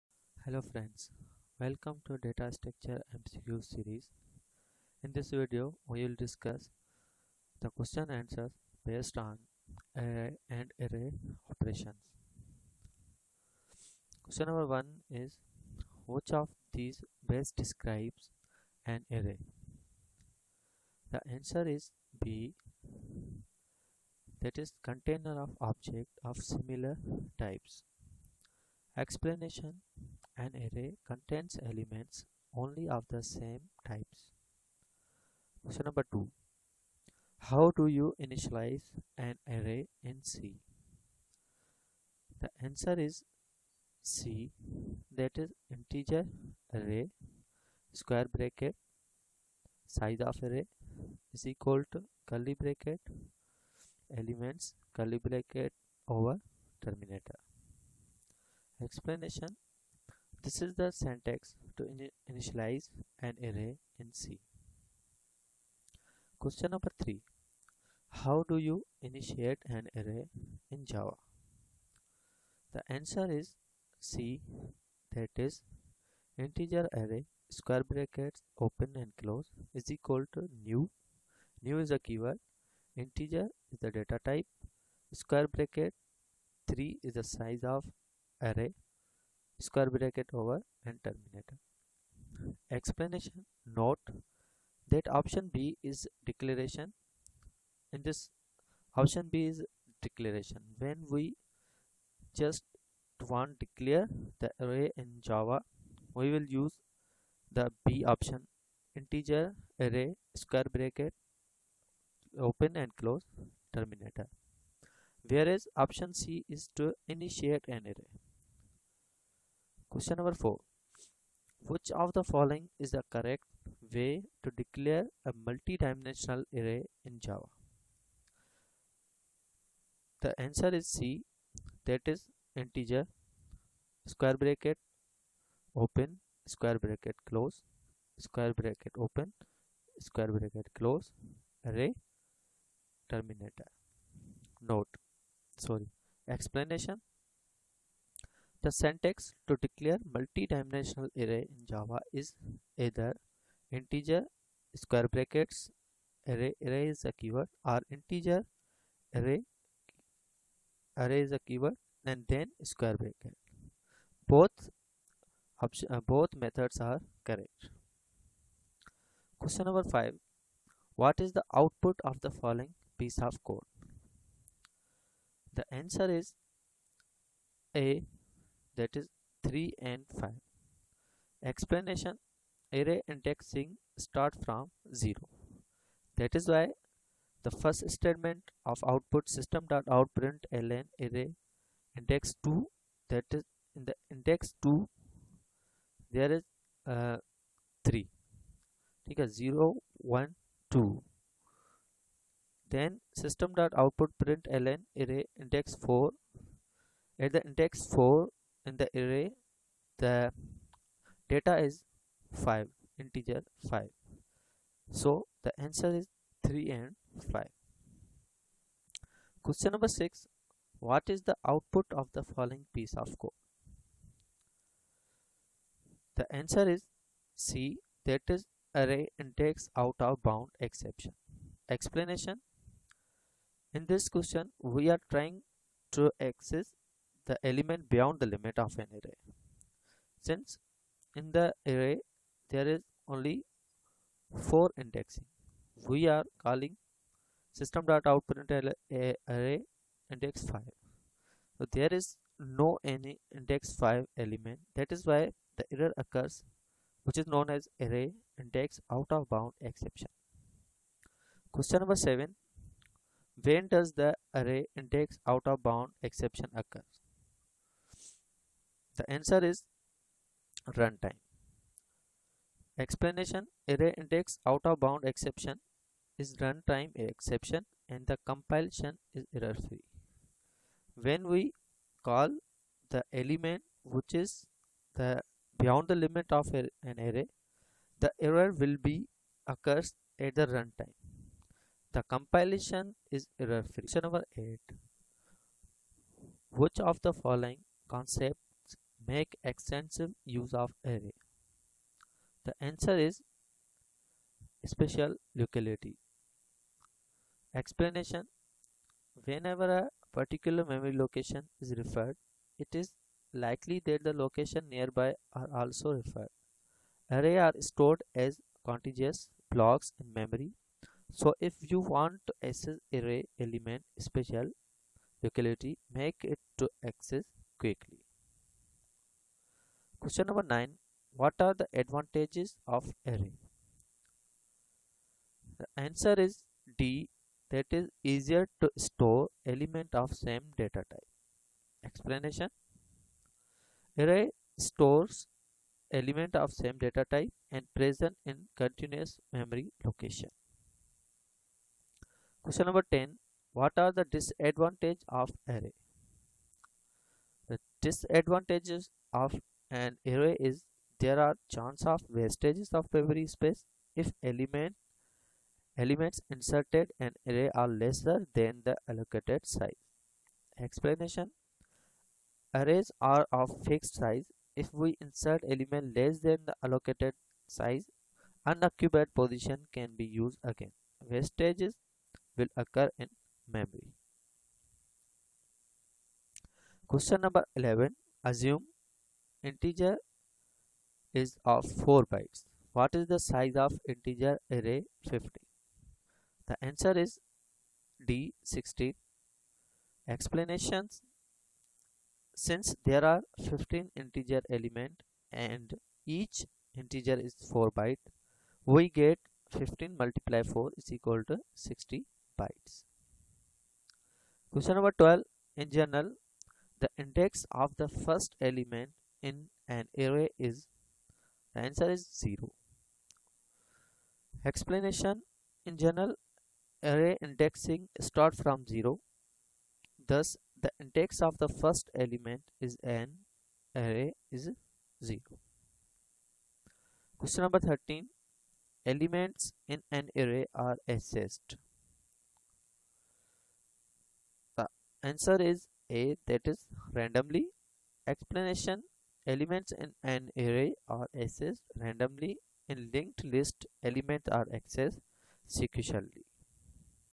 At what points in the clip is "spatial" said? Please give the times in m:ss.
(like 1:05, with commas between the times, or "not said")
5:04, 5:23.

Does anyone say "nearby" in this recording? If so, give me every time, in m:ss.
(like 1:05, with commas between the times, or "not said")
5:14.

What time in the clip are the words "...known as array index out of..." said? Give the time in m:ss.
4:17.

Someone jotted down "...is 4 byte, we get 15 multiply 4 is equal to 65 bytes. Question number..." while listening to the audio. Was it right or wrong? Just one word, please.
wrong.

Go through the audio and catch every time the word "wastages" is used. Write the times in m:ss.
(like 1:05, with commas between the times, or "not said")
6:02, 6:21.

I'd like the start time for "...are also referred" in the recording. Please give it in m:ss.
5:15.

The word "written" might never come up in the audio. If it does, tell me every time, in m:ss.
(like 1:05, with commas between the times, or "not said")
not said.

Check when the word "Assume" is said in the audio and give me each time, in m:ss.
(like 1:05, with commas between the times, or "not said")
6:28.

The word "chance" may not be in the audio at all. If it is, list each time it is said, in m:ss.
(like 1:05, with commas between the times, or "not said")
6:01.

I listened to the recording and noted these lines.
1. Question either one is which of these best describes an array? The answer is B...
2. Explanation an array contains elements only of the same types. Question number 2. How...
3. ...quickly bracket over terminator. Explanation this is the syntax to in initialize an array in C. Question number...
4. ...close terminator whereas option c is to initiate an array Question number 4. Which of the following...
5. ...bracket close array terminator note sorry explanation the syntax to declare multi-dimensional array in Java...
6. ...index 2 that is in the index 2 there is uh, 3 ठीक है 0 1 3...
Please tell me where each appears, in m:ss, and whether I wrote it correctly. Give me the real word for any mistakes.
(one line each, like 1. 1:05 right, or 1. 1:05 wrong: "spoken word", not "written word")
1. 0:14 wrong: "number", not "either"
2. 0:28 right
3. 0:54 wrong: "curly", not "quickly"
4. 1:53 right
5. 2:20 right
6. 3:11 wrong: "2", not "3".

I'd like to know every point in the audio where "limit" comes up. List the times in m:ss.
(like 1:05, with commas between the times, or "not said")
3:58, 4:46.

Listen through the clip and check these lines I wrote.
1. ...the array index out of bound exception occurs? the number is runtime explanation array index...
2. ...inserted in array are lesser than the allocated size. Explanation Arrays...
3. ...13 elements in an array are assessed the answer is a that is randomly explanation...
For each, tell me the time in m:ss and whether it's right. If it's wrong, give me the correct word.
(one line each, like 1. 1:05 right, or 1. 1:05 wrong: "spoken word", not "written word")
1. 4:23 wrong: "answer", not "number"
2. 6:06 right
3. 7:17 right.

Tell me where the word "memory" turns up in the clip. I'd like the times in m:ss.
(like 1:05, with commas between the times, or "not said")
5:10, 5:20, 5:49, 6:02, 6:23.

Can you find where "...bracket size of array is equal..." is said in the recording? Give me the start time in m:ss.
0:48.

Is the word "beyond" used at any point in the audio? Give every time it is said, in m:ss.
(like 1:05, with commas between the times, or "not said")
3:57, 4:45.